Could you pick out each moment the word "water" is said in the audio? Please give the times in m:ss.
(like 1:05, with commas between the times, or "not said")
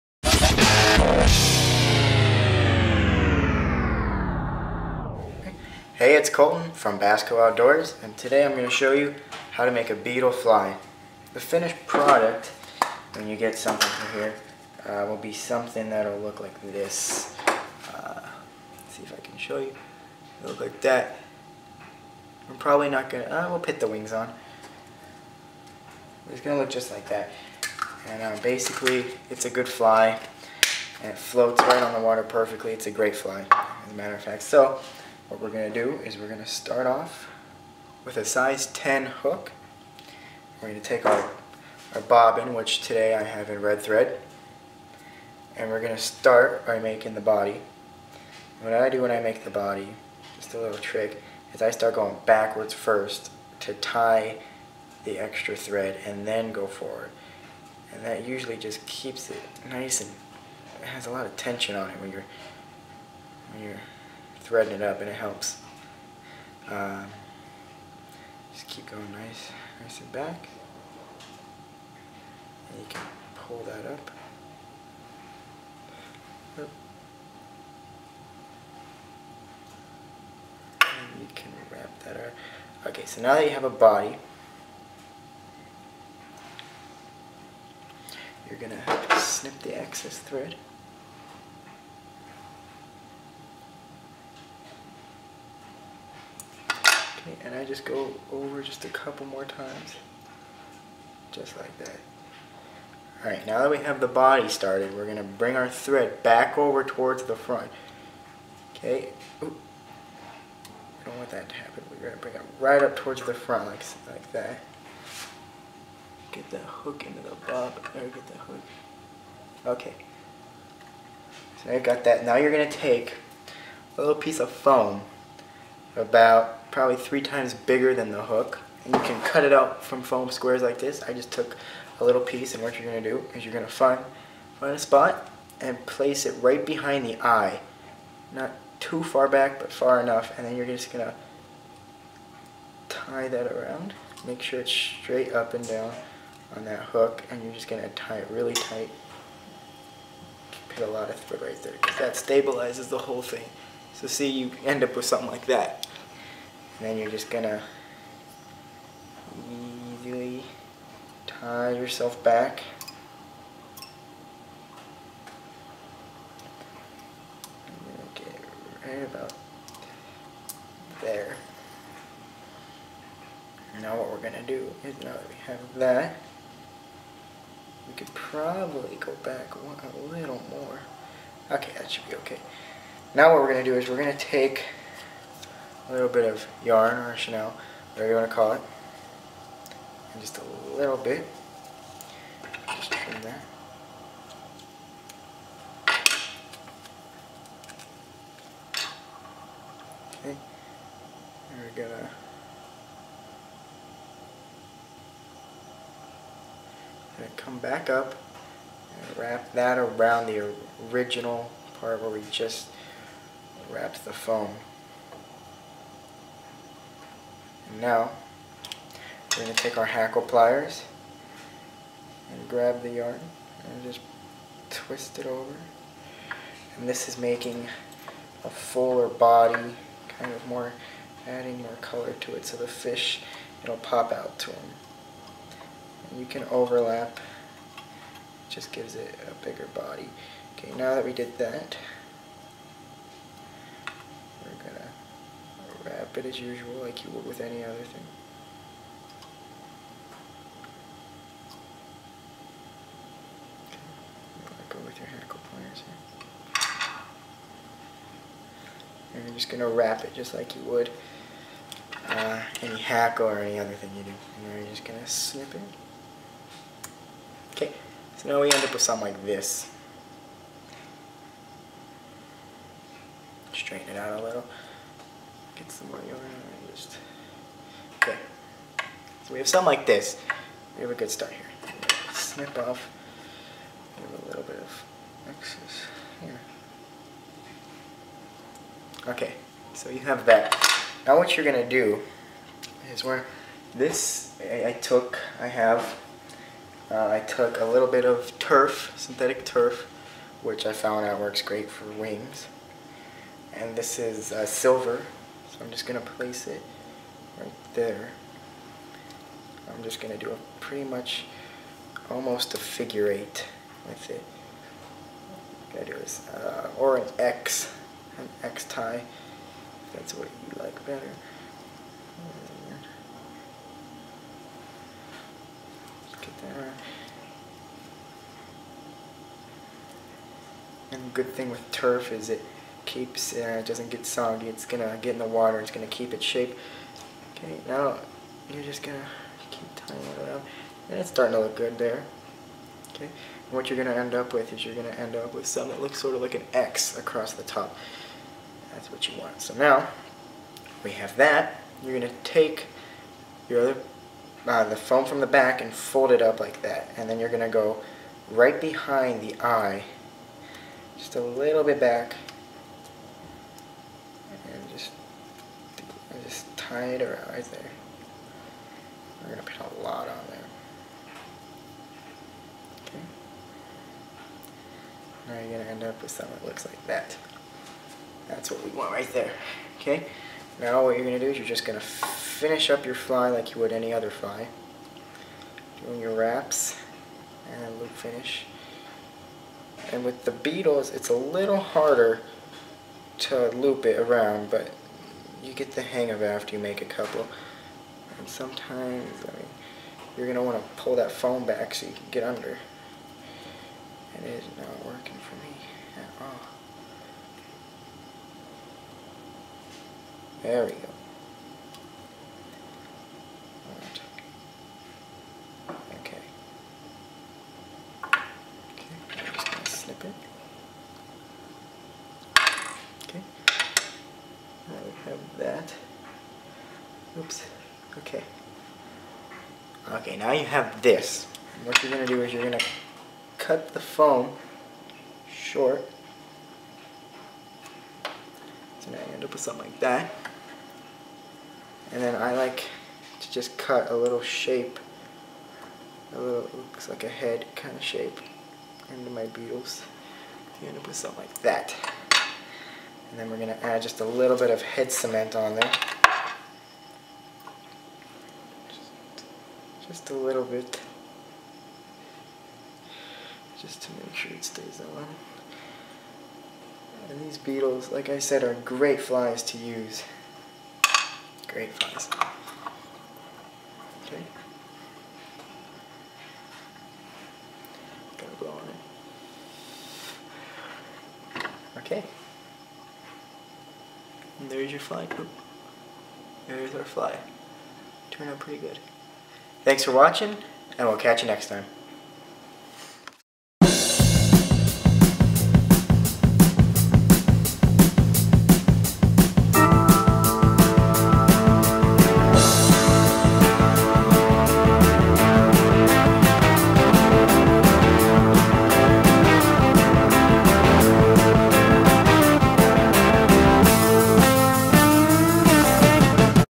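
0:31, 5:35.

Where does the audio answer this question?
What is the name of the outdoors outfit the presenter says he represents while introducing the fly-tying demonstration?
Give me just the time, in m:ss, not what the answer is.
0:06.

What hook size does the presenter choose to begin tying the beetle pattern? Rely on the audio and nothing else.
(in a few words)
10.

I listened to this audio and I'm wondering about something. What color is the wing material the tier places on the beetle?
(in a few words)
Silver.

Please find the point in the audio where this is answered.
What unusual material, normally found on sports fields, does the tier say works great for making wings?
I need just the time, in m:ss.
4:58.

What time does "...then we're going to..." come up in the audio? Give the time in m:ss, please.
7:33.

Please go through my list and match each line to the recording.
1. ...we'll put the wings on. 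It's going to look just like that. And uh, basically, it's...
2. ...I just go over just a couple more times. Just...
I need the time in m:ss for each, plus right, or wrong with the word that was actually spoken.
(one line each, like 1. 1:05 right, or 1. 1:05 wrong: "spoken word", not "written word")
1. 0:23 right
2. 1:37 right.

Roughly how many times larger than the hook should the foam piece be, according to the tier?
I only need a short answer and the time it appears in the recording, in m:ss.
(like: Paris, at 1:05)
3, at 2:06.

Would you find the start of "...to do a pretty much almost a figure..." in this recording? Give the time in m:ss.
5:10.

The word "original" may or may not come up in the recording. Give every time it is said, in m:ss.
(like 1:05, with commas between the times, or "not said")
3:30.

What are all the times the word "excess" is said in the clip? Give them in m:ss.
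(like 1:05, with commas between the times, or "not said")
1:29, 4:45.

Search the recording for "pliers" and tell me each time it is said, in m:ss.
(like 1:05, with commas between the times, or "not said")
3:40, 4:15.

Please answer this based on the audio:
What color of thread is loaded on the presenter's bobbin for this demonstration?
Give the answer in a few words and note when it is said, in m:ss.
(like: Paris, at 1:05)
Red, at 0:43.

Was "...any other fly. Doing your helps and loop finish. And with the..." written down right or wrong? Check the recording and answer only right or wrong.
wrong.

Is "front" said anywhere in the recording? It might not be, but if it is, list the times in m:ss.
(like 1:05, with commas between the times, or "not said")
1:47, 1:53.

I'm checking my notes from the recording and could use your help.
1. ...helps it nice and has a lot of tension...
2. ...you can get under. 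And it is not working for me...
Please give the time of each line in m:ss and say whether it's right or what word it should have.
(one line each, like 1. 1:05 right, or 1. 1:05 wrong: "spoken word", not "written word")
1. 0:58 wrong: "keeps", not "helps"
2. 6:41 right.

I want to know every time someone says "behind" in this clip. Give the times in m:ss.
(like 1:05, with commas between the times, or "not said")
2:16, 5:58.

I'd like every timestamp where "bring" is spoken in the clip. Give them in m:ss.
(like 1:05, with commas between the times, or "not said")
1:45, 1:52.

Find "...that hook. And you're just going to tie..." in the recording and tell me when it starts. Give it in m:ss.
2:26.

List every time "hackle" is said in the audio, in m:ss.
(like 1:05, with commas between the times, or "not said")
3:39, 4:15, 4:22.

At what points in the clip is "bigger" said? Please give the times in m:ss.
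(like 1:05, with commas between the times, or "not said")
2:07, 3:59.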